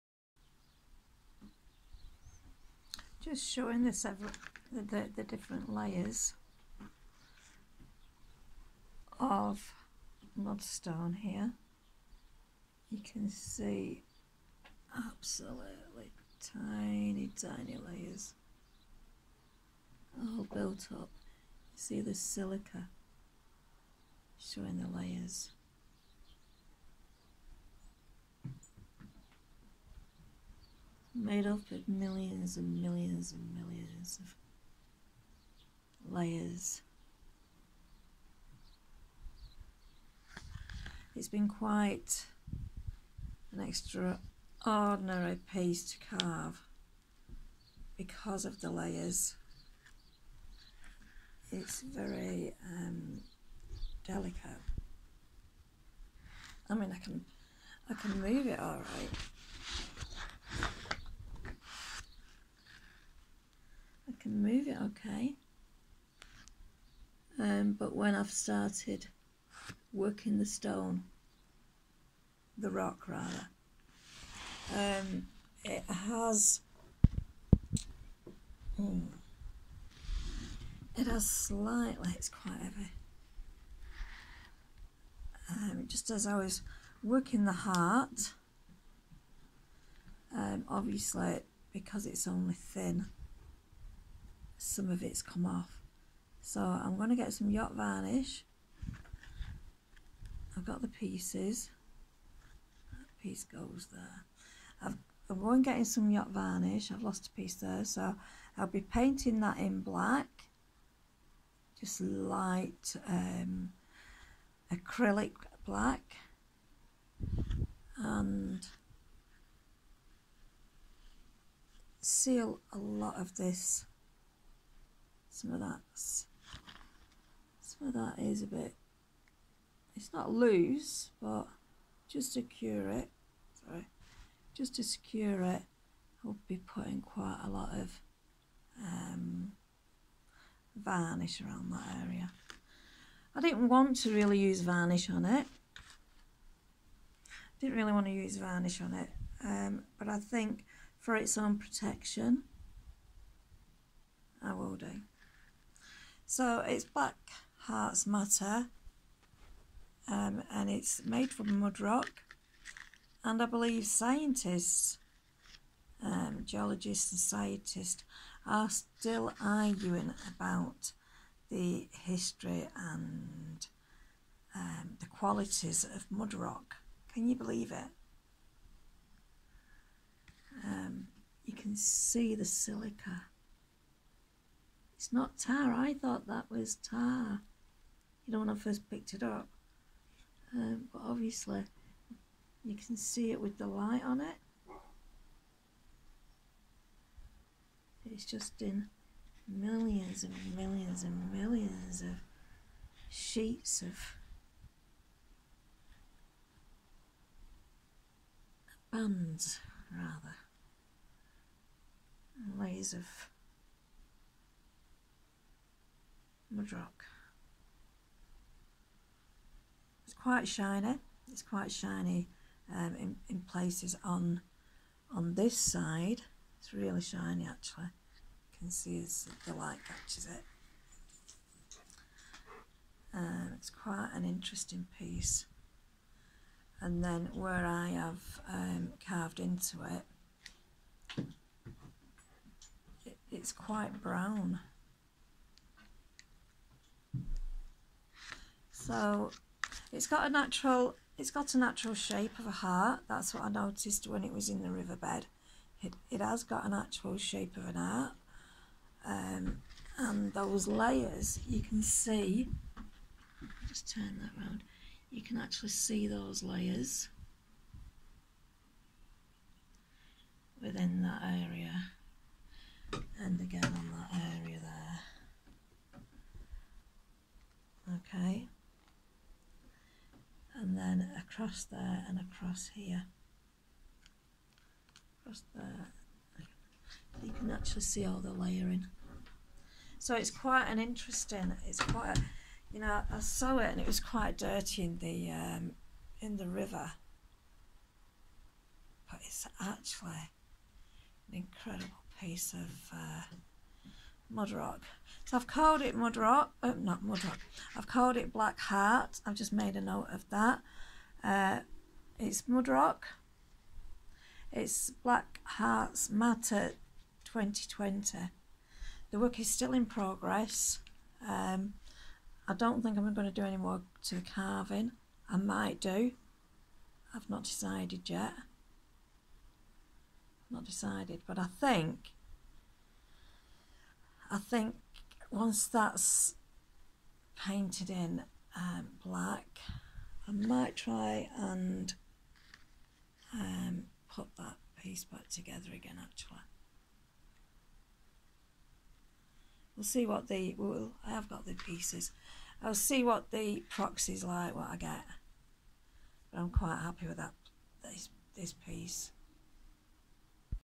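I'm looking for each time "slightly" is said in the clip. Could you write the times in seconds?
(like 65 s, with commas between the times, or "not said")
81 s.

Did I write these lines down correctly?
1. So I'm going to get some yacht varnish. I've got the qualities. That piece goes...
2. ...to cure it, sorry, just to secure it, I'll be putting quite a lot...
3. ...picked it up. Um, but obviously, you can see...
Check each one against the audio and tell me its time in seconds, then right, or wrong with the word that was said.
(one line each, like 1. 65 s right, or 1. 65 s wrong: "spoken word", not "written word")
1. 96 s wrong: "pieces", not "qualities"
2. 132 s right
3. 188 s right.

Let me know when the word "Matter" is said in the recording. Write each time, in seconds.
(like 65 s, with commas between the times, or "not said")
158 s, 316 s.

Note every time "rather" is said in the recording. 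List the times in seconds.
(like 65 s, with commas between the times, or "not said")
73 s, 209 s.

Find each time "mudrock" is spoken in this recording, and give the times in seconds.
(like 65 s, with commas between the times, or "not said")
216 s, 312 s.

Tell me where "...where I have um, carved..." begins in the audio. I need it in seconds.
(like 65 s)
237 s.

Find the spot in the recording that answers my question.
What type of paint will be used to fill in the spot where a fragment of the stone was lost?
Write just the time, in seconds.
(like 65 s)
114 s.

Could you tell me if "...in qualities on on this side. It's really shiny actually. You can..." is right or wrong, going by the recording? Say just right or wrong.
wrong.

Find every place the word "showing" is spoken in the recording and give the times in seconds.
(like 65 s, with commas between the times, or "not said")
3 s, 24 s.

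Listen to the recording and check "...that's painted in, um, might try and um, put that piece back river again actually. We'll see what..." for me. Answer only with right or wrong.
wrong.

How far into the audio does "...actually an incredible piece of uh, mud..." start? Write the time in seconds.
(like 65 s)
299 s.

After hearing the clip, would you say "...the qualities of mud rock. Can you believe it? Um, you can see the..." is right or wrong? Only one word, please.
right.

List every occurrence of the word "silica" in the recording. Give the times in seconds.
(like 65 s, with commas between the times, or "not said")
22 s, 182 s.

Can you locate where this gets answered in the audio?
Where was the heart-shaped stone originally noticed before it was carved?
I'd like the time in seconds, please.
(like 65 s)
254 s.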